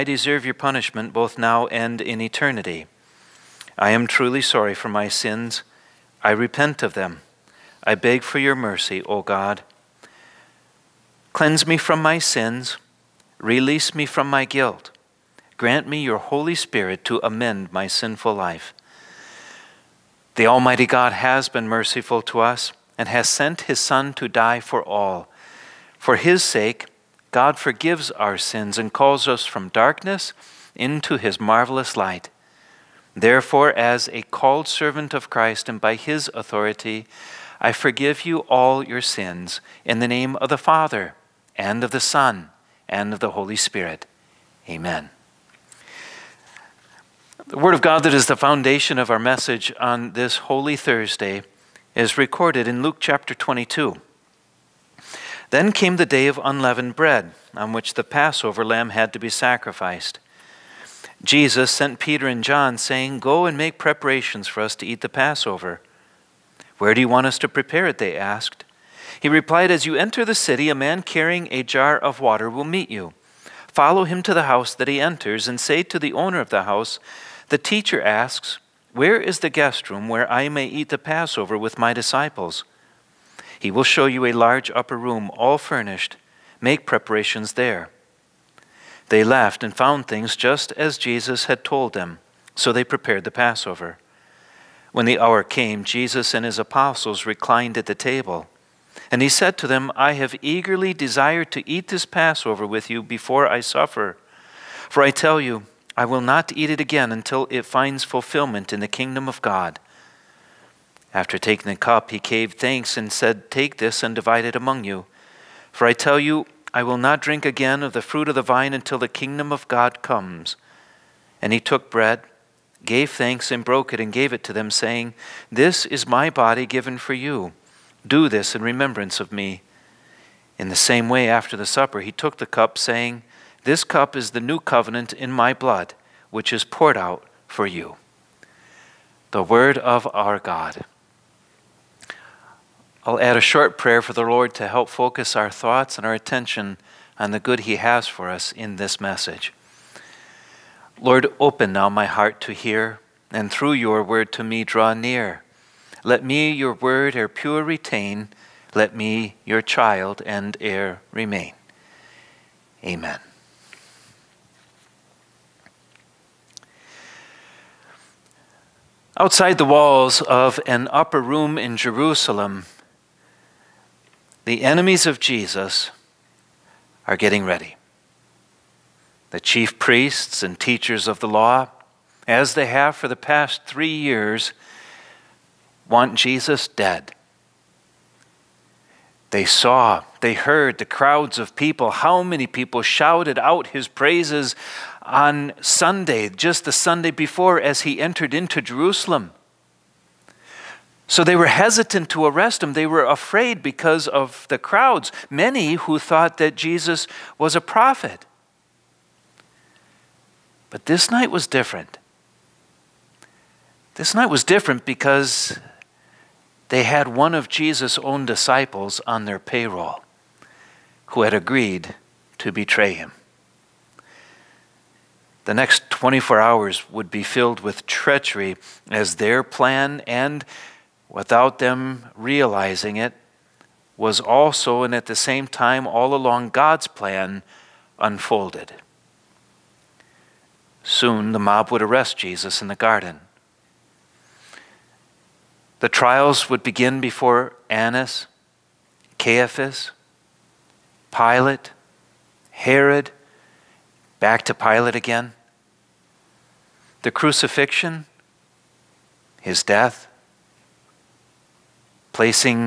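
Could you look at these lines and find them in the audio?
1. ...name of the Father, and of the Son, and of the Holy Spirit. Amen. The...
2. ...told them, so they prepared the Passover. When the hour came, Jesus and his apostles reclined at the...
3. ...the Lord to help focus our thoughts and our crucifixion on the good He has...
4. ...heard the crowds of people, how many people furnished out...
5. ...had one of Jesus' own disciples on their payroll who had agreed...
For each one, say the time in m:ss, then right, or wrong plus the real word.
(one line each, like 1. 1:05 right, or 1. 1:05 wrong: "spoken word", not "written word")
1. 0:40 right
2. 1:31 right
3. 2:24 wrong: "attention", not "crucifixion"
4. 3:10 wrong: "shouted", not "furnished"
5. 3:36 right.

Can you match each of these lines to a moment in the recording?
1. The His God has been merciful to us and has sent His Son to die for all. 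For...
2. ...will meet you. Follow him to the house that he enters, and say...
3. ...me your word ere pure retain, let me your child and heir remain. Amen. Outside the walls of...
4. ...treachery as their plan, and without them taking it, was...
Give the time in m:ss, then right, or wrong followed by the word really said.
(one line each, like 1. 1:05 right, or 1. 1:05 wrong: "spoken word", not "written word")
1. 0:20 wrong: "Almighty", not "His"
2. 1:12 right
3. 2:36 right
4. 3:47 wrong: "realizing", not "taking".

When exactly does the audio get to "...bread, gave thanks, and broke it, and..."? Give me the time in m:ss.
2:01.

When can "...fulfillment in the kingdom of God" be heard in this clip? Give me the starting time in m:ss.
1:48.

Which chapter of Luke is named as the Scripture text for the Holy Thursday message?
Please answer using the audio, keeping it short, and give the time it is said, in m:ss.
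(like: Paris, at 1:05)
Chapter 22, at 0:52.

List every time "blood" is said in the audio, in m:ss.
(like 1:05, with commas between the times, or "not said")
2:15.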